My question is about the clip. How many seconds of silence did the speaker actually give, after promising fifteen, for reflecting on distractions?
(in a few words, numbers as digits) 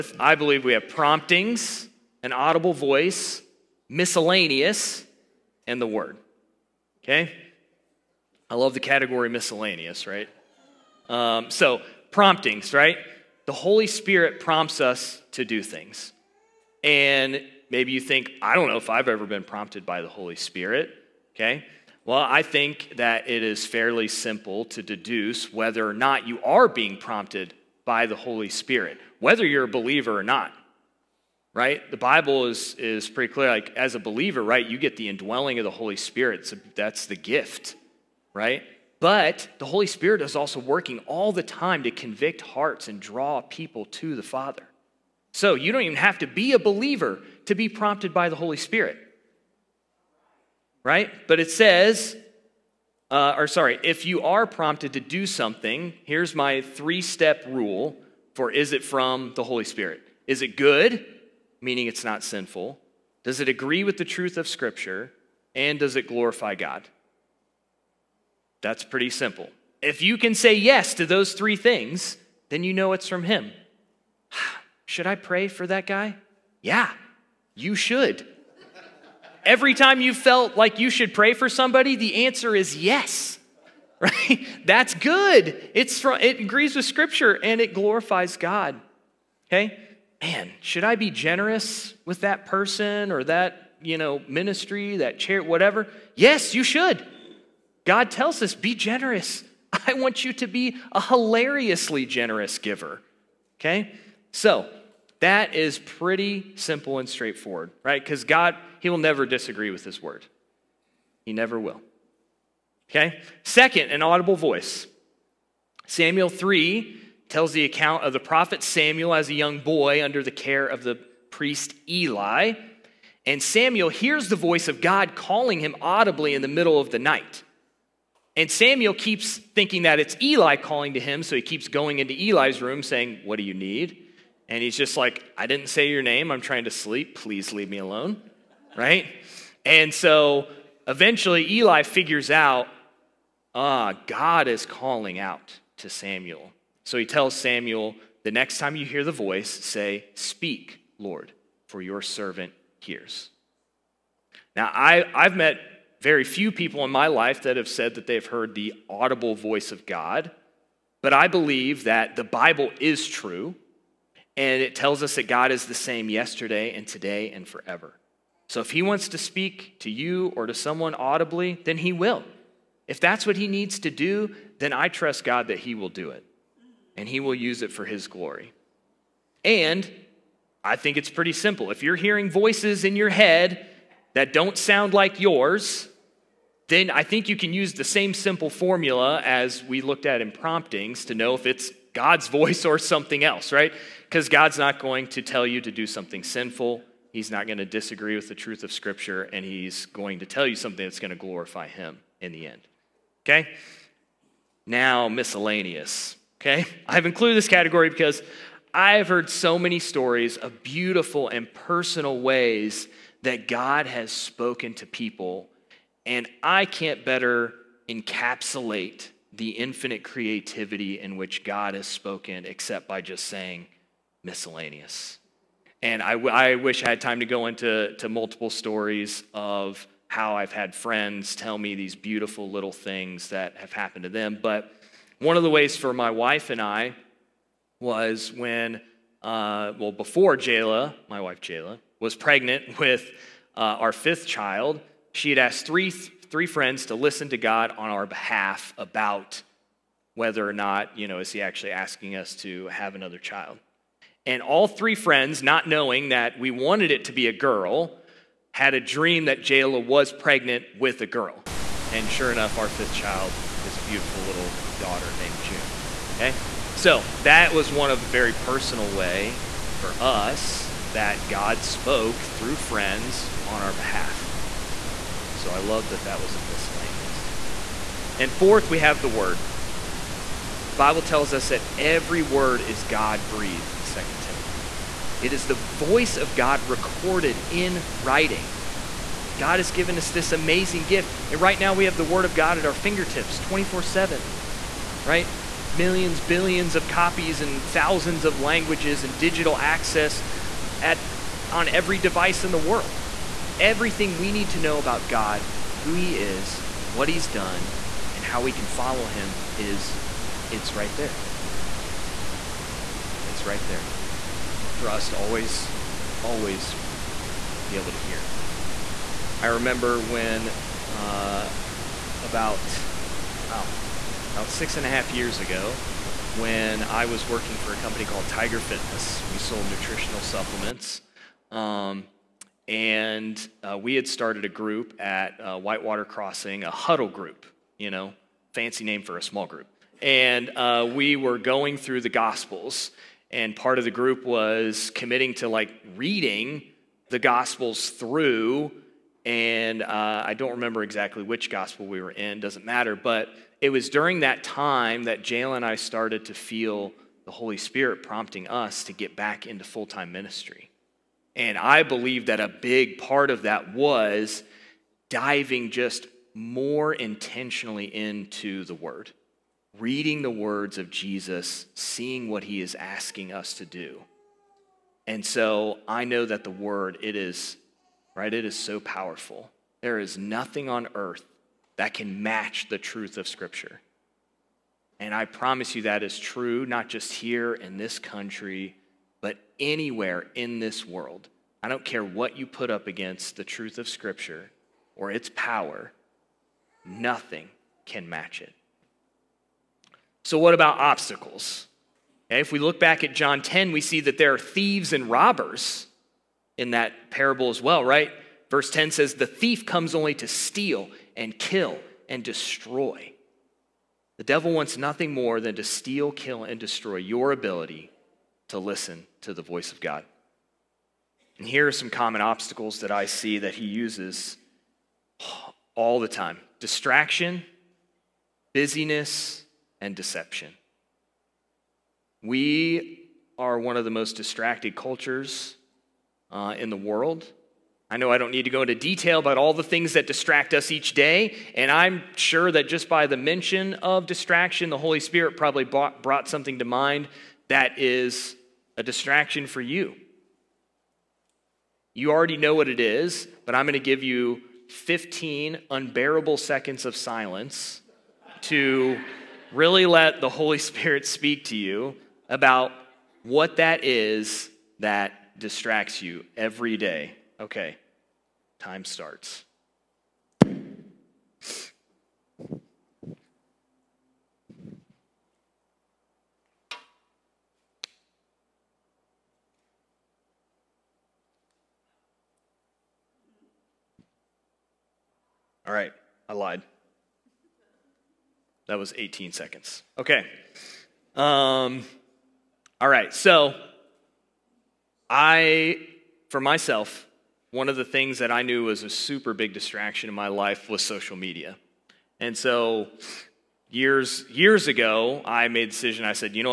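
18.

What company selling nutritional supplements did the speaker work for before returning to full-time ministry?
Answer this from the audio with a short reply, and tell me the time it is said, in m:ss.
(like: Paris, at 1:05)
Tiger Fitness, at 5:28.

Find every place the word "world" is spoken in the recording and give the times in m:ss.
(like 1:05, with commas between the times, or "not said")
5:02, 6:30, 7:16.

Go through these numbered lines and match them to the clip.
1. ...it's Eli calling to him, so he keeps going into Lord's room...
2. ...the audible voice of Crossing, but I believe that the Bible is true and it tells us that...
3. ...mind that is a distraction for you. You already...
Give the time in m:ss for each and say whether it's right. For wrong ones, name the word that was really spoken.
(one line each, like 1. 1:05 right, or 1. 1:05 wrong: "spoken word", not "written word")
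1. 2:09 wrong: "Eli", not "Lord"
2. 2:38 wrong: "God", not "Crossing"
3. 7:26 right.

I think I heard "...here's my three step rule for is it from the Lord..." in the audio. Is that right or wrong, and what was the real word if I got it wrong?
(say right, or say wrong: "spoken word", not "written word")
wrong: "Holy", not "Lord".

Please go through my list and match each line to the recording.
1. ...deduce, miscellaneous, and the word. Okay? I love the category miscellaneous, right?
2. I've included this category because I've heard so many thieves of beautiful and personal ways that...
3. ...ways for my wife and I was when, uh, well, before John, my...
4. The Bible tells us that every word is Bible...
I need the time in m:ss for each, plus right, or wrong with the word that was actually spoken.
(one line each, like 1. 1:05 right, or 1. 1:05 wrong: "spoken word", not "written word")
1. 0:02 wrong: "voice", not "deduce"
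2. 3:26 wrong: "stories", not "thieves"
3. 3:55 wrong: "Jayla", not "John"
4. 4:40 wrong: "God", not "Bible".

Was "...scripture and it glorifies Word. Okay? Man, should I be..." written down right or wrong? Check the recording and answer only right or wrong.
wrong.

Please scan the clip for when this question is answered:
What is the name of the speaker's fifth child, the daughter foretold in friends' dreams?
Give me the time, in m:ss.
4:25.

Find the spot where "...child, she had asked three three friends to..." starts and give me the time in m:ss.
4:04.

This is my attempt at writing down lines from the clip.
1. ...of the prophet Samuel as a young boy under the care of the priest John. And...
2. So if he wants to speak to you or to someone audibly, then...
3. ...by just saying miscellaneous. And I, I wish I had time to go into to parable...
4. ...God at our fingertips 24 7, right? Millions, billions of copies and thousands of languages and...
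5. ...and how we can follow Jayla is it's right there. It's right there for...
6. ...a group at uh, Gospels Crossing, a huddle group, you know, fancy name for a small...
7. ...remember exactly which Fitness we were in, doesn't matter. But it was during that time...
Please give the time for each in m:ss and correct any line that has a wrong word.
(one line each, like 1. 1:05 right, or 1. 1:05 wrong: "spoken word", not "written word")
1. 1:58 wrong: "Eli", not "John"
2. 2:48 right
3. 3:42 wrong: "multiple", not "parable"
4. 4:52 right
5. 5:08 wrong: "Him", not "Jayla"
6. 5:34 wrong: "Whitewater", not "Gospels"
7. 5:50 wrong: "Gospel", not "Fitness".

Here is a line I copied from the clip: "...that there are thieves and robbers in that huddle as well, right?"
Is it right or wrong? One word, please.
wrong.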